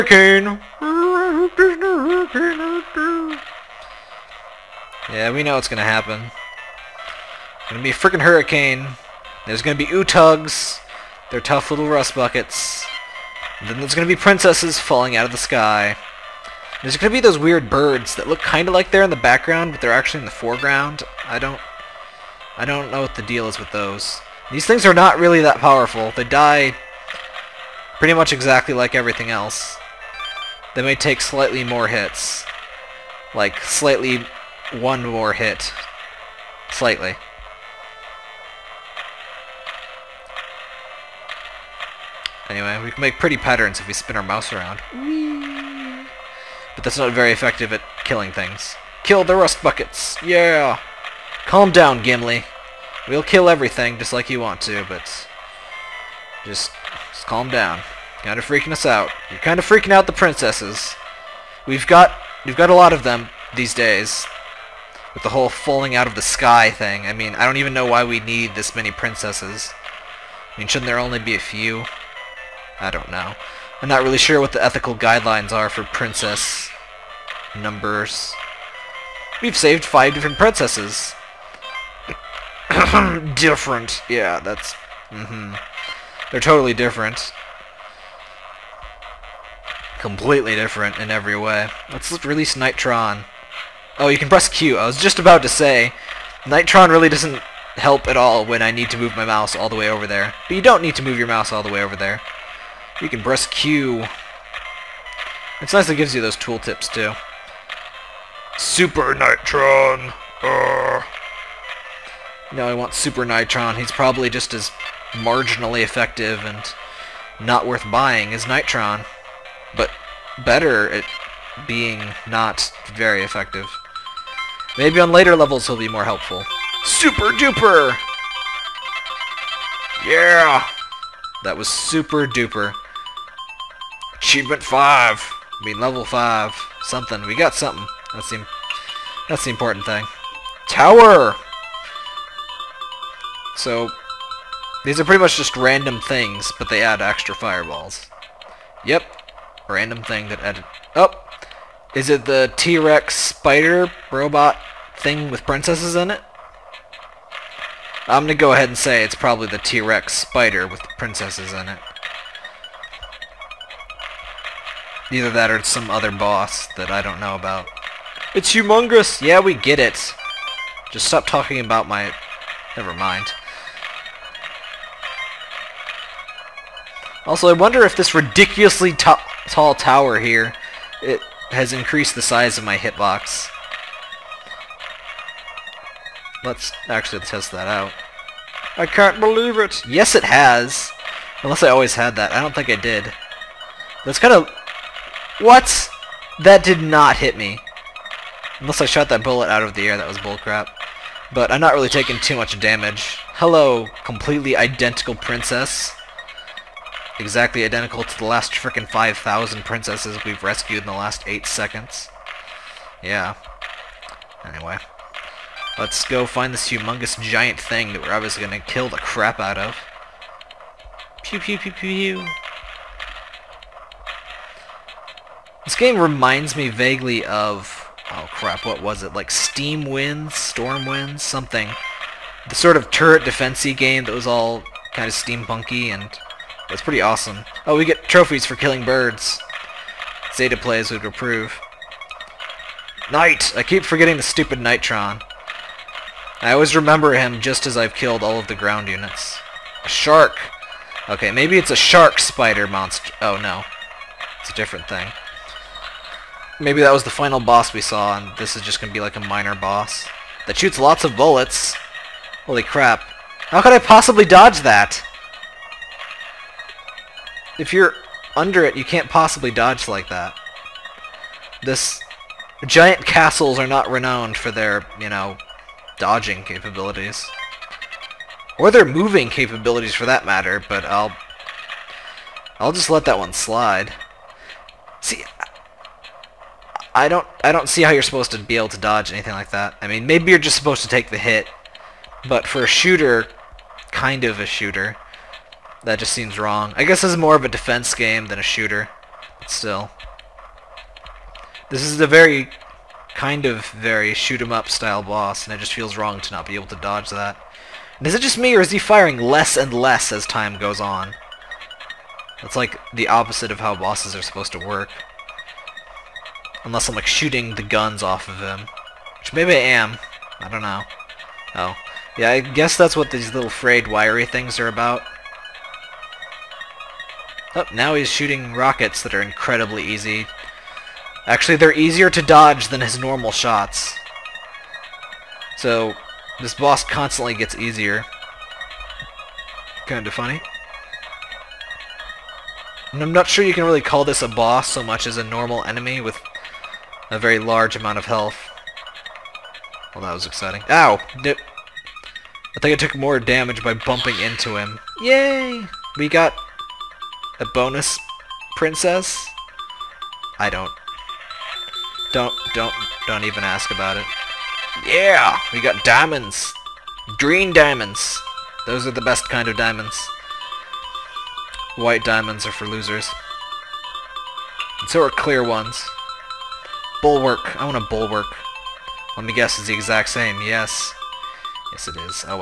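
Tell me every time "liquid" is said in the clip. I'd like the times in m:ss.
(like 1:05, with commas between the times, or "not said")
not said.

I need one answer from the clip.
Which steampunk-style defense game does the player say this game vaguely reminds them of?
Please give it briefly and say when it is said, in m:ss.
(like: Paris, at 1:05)
Steam Winds, at 3:49.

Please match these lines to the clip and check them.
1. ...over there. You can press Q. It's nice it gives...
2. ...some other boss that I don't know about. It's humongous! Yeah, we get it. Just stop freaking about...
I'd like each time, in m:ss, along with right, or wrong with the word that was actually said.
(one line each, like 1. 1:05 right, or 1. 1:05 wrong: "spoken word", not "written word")
1. 1:41 right
2. 2:45 wrong: "talking", not "freaking".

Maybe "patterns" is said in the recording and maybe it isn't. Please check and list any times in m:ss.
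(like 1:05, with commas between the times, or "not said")
0:43.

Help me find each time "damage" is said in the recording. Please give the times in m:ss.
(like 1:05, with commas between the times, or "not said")
3:22, 5:53.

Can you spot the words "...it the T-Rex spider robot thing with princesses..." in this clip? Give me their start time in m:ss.
2:32.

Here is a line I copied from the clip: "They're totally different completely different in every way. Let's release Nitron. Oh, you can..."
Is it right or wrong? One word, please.
right.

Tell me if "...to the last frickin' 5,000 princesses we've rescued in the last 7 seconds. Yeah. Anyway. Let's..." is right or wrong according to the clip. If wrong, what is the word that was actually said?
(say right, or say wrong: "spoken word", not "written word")
wrong: "8", not "7".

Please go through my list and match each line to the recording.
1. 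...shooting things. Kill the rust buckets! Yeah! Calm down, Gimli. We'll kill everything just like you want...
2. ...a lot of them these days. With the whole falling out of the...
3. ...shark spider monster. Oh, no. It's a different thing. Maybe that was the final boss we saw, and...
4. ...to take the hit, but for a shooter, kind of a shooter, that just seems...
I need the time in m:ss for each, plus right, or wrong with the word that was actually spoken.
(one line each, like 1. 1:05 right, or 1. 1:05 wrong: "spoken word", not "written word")
1. 0:48 wrong: "killing", not "shooting"
2. 1:02 right
3. 4:11 right
4. 4:50 right.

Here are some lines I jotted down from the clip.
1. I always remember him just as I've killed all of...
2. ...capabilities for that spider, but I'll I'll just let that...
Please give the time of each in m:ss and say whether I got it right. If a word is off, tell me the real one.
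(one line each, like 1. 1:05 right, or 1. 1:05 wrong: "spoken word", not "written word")
1. 4:06 right
2. 4:39 wrong: "matter", not "spider".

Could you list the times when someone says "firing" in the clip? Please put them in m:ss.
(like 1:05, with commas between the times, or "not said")
5:08.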